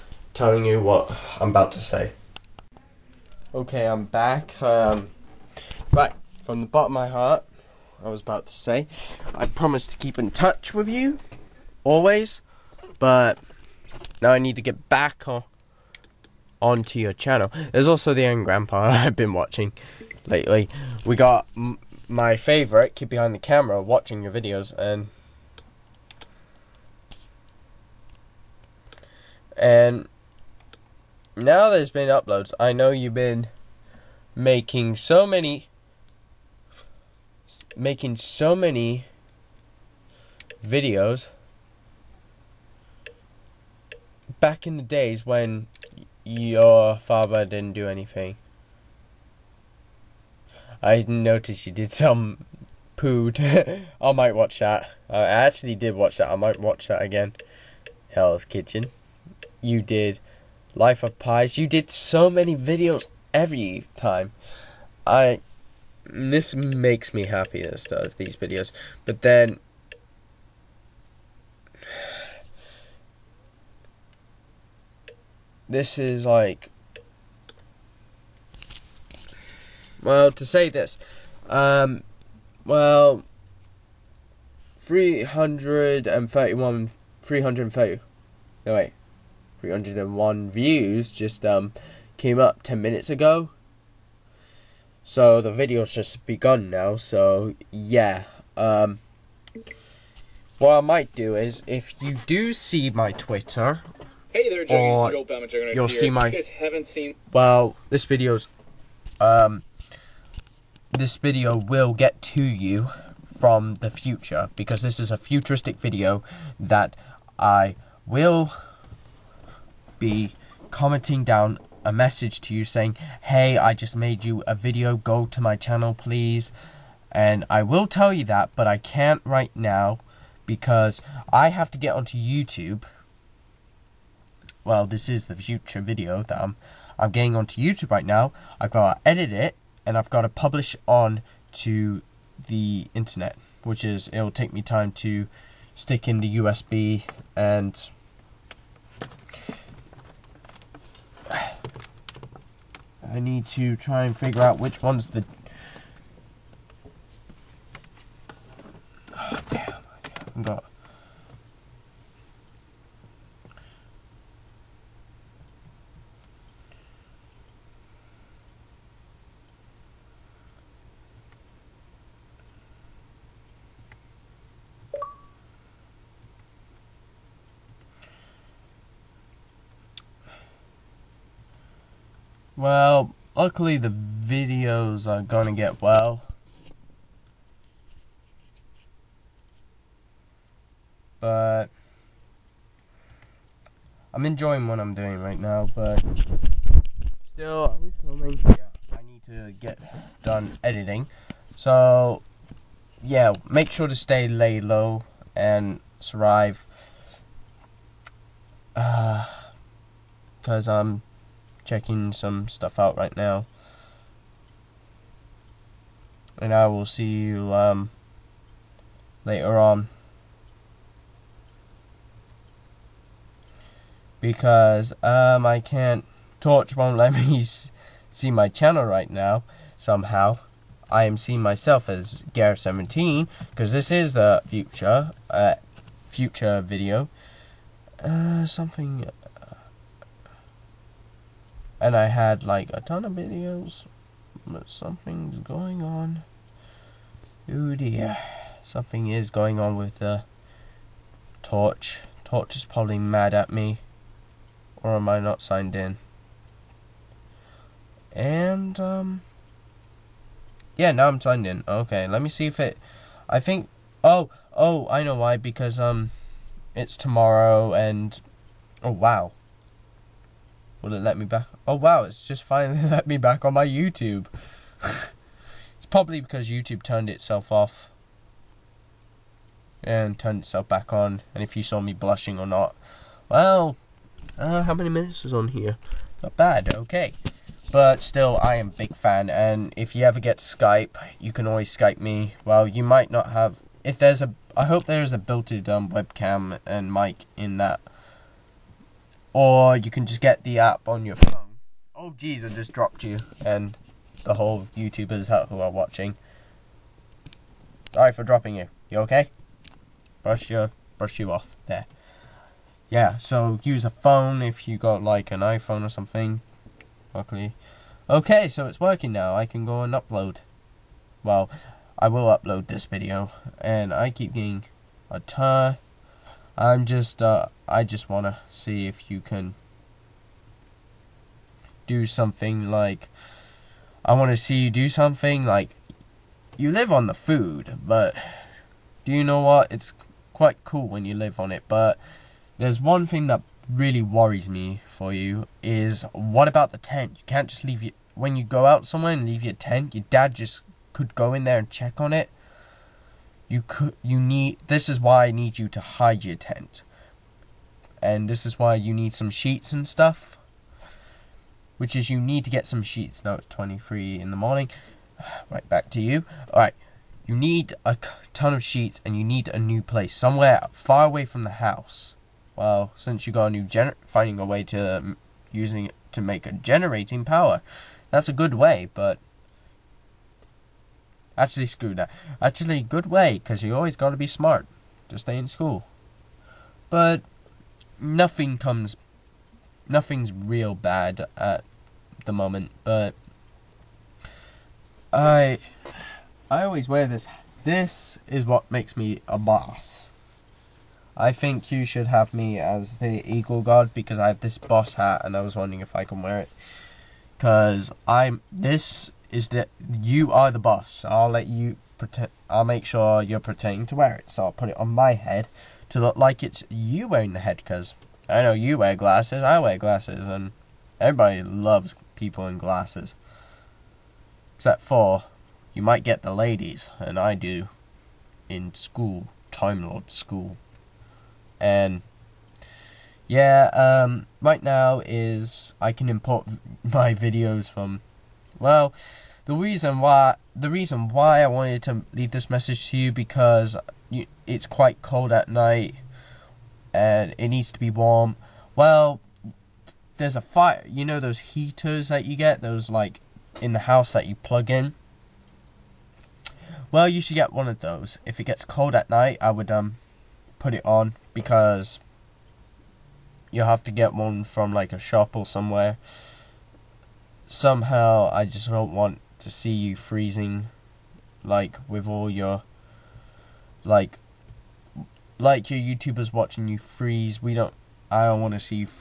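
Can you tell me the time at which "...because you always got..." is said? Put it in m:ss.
6:23.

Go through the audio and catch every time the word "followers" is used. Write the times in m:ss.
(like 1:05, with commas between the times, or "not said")
not said.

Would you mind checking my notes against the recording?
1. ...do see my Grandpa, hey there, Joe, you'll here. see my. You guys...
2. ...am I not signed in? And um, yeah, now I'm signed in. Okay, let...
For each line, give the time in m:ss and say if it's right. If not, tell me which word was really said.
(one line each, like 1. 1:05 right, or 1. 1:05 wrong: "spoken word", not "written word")
1. 1:42 wrong: "Twitter", not "Grandpa"
2. 4:14 right.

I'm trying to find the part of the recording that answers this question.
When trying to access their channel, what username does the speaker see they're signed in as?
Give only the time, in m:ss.
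3:52.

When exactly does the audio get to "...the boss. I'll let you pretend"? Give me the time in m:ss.
6:50.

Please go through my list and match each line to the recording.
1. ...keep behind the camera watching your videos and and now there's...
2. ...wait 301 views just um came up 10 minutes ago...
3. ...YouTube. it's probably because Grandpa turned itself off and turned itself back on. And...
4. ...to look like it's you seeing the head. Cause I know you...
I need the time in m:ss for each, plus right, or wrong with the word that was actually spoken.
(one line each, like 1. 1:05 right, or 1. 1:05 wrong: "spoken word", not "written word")
1. 0:22 right
2. 1:28 right
3. 4:33 wrong: "YouTube", not "Grandpa"
4. 6:55 wrong: "wearing", not "seeing".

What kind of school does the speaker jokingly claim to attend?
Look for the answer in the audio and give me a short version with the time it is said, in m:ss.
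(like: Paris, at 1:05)
Time Lord school, at 7:09.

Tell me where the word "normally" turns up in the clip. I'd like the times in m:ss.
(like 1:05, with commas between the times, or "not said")
not said.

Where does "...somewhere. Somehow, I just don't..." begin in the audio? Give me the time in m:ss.
7:45.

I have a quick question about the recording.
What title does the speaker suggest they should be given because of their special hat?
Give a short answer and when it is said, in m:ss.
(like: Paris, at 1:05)
Eagle God, at 6:43.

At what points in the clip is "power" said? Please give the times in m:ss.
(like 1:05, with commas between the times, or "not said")
6:17.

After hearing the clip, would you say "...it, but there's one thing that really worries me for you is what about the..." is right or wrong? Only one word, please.
right.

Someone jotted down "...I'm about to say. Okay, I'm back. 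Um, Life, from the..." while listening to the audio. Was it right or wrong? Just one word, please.
wrong.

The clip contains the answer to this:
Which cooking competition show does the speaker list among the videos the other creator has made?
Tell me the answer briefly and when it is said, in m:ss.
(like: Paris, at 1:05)
Hell's Kitchen, at 0:58.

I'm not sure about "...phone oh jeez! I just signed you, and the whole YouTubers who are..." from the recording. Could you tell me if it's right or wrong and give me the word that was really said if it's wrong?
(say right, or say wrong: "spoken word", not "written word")
wrong: "dropped", not "signed".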